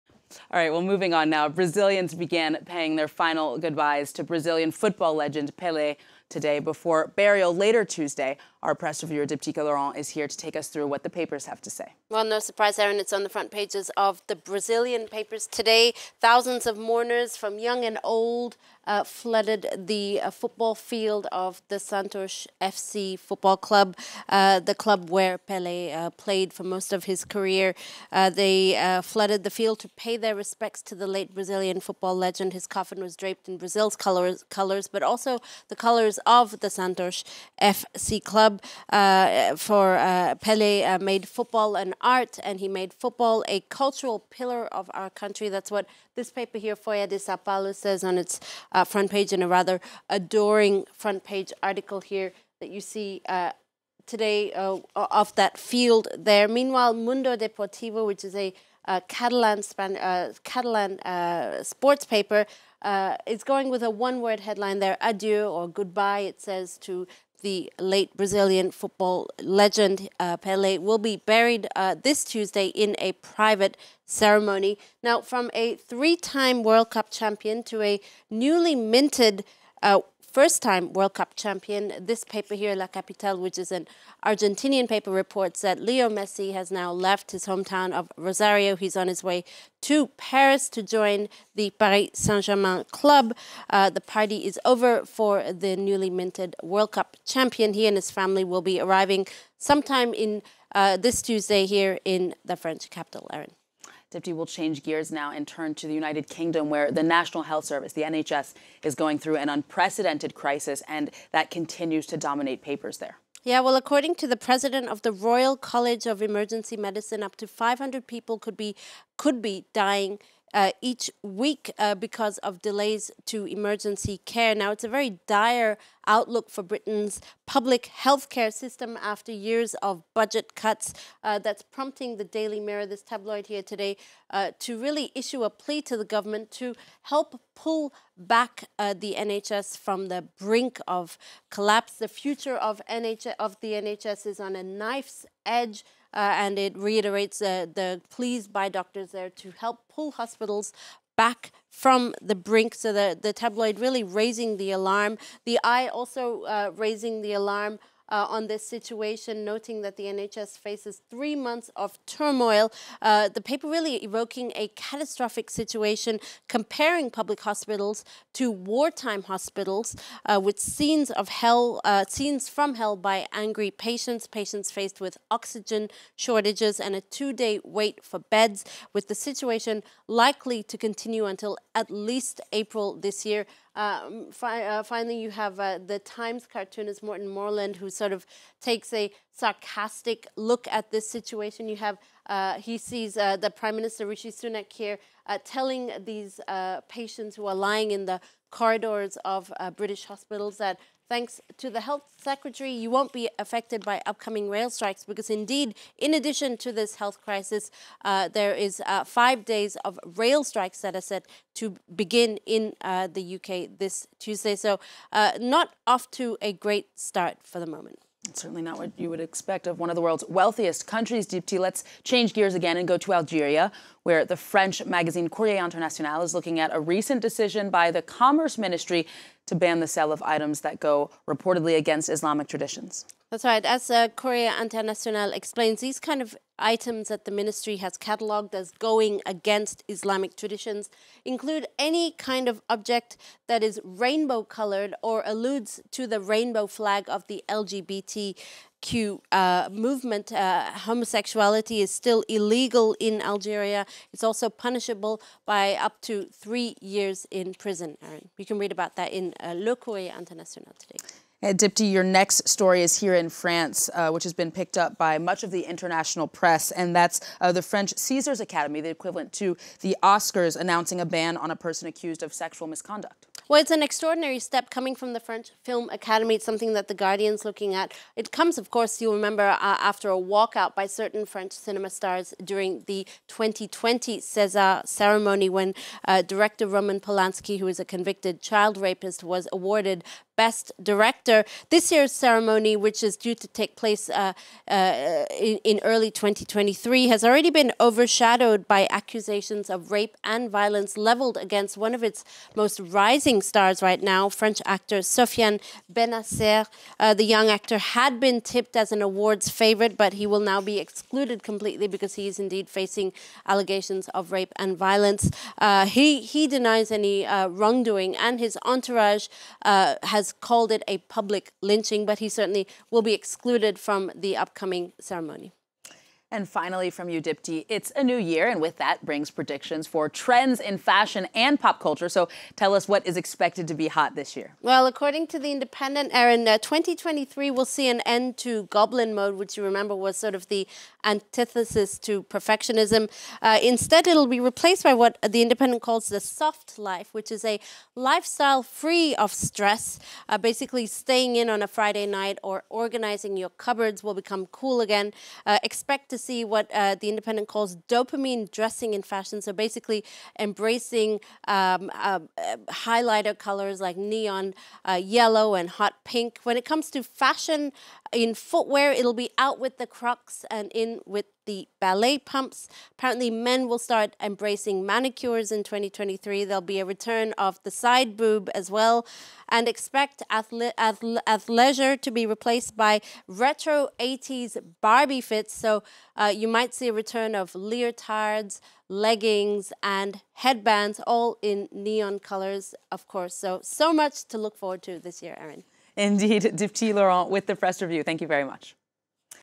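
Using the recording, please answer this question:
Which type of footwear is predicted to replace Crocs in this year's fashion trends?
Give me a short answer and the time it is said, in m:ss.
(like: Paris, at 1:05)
ballet pumps, at 6:11.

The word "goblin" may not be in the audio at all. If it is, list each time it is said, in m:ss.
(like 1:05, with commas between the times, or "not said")
5:38.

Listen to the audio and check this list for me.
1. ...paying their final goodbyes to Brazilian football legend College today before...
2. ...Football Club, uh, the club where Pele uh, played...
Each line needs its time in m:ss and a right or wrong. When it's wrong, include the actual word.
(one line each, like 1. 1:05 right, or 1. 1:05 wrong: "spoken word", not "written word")
1. 0:02 wrong: "Pele", not "College"
2. 0:23 right.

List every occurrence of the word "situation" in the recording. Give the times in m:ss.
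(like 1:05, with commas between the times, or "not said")
2:38, 2:45, 2:59, 3:11.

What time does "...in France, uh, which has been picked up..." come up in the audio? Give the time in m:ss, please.
4:23.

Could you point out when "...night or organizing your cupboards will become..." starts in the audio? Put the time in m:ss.
5:52.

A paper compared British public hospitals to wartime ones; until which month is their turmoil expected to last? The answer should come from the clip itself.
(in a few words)
April.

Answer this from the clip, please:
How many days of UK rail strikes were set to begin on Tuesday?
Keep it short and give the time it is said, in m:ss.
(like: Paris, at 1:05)
5, at 3:29.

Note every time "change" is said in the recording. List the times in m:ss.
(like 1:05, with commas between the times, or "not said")
1:44, 3:42.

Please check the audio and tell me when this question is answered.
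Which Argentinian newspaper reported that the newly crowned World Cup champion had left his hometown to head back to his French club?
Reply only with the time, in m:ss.
1:22.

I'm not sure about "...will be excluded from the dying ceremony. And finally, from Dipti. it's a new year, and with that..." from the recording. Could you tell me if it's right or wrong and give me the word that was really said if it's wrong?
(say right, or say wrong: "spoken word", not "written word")
wrong: "upcoming", not "dying".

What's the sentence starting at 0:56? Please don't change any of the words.
Meanwhile, Mundo Deportivo, which is a uh, Catalan, Span- uh, Catalan uh, sports paper.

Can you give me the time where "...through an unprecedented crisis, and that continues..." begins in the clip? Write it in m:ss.
1:49.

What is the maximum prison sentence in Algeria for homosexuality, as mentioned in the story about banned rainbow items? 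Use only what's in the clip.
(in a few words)
3 years.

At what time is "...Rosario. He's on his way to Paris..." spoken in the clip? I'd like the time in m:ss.
1:28.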